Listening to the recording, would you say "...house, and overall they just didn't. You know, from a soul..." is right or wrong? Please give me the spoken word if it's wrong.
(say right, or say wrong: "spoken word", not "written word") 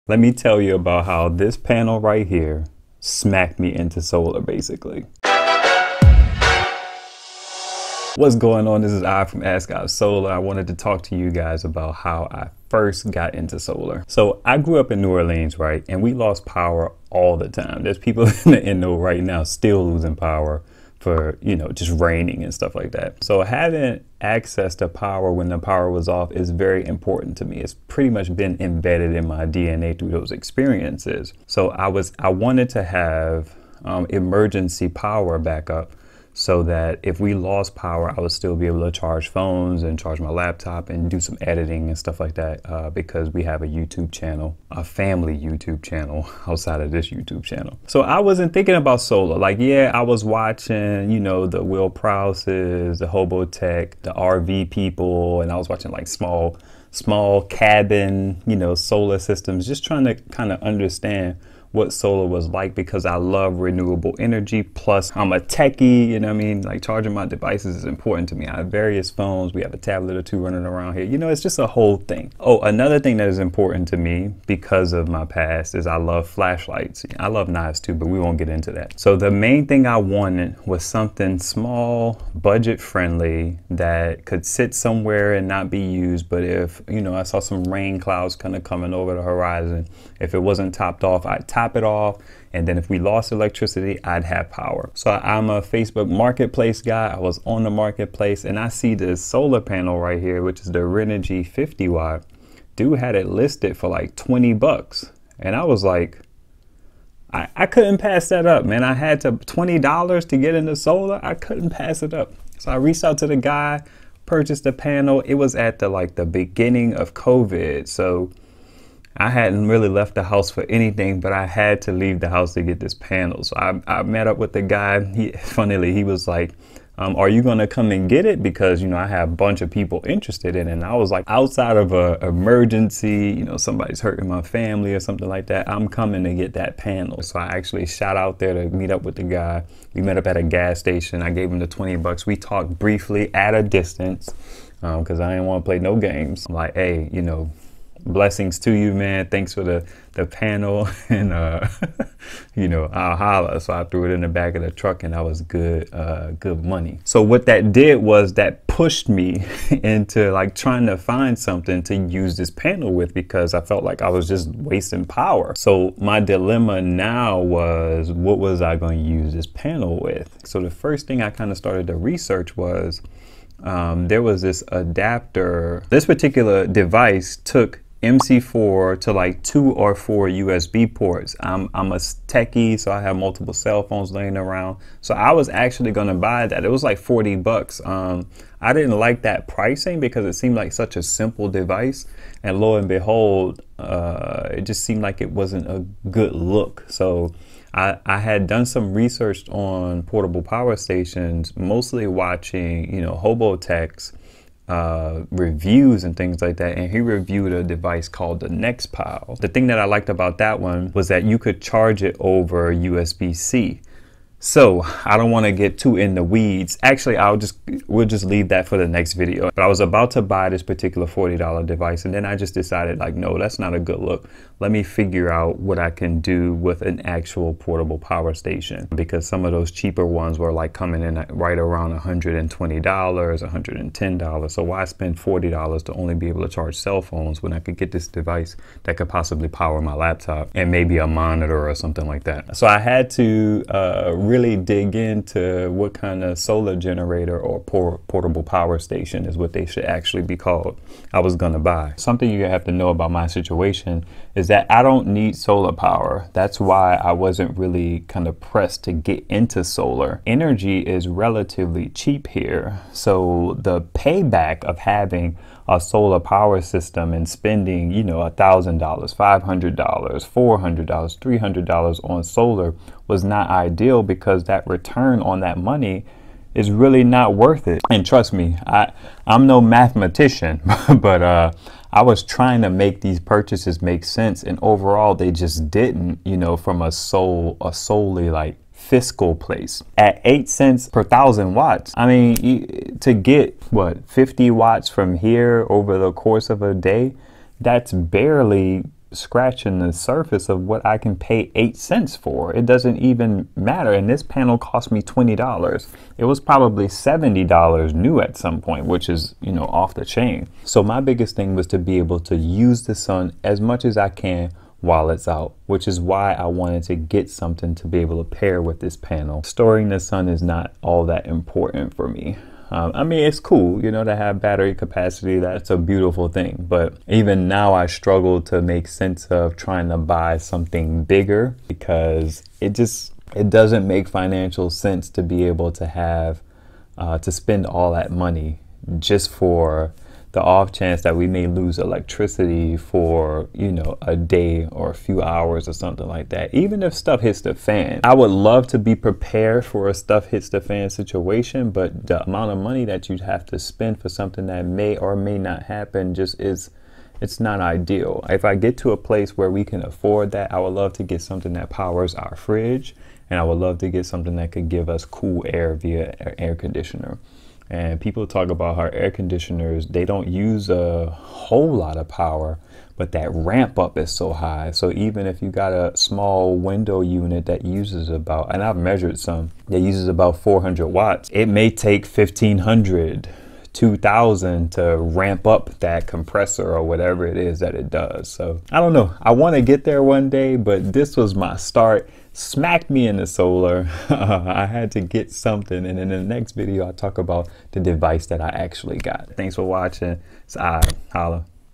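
wrong: "sense", not "house".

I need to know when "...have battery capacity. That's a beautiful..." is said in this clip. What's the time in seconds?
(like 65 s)
324 s.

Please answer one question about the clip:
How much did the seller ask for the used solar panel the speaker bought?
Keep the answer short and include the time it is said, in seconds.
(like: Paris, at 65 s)
$20, at 103 s.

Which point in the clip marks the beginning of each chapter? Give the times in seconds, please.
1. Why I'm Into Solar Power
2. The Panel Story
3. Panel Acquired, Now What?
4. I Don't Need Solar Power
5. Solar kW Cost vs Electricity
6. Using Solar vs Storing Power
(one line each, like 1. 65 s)
1. 14 s
2. 94 s
3. 156 s
4. 250 s
5. 289 s
6. 310 s.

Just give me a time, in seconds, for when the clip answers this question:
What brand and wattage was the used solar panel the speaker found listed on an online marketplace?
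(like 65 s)
100 s.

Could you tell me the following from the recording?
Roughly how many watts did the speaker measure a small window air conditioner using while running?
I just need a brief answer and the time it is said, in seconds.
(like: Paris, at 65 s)
400 watts, at 380 s.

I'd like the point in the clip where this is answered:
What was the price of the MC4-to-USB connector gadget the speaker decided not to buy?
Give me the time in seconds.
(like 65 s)
186 s.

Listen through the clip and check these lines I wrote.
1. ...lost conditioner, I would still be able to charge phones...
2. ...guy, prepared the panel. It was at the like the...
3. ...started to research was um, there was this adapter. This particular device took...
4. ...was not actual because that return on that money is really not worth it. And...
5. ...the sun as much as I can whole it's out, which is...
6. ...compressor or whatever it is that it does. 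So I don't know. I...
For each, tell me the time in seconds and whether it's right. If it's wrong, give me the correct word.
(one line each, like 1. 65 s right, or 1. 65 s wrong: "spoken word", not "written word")
1. 37 s wrong: "power", not "conditioner"
2. 113 s wrong: "purchased", not "prepared"
3. 171 s right
4. 273 s wrong: "ideal", not "actual"
5. 312 s wrong: "while", not "whole"
6. 386 s right.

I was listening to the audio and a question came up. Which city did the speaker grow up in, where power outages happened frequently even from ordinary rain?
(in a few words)
New Orleans.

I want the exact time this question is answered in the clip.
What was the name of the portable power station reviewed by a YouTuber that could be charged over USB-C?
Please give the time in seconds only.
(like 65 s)
208 s.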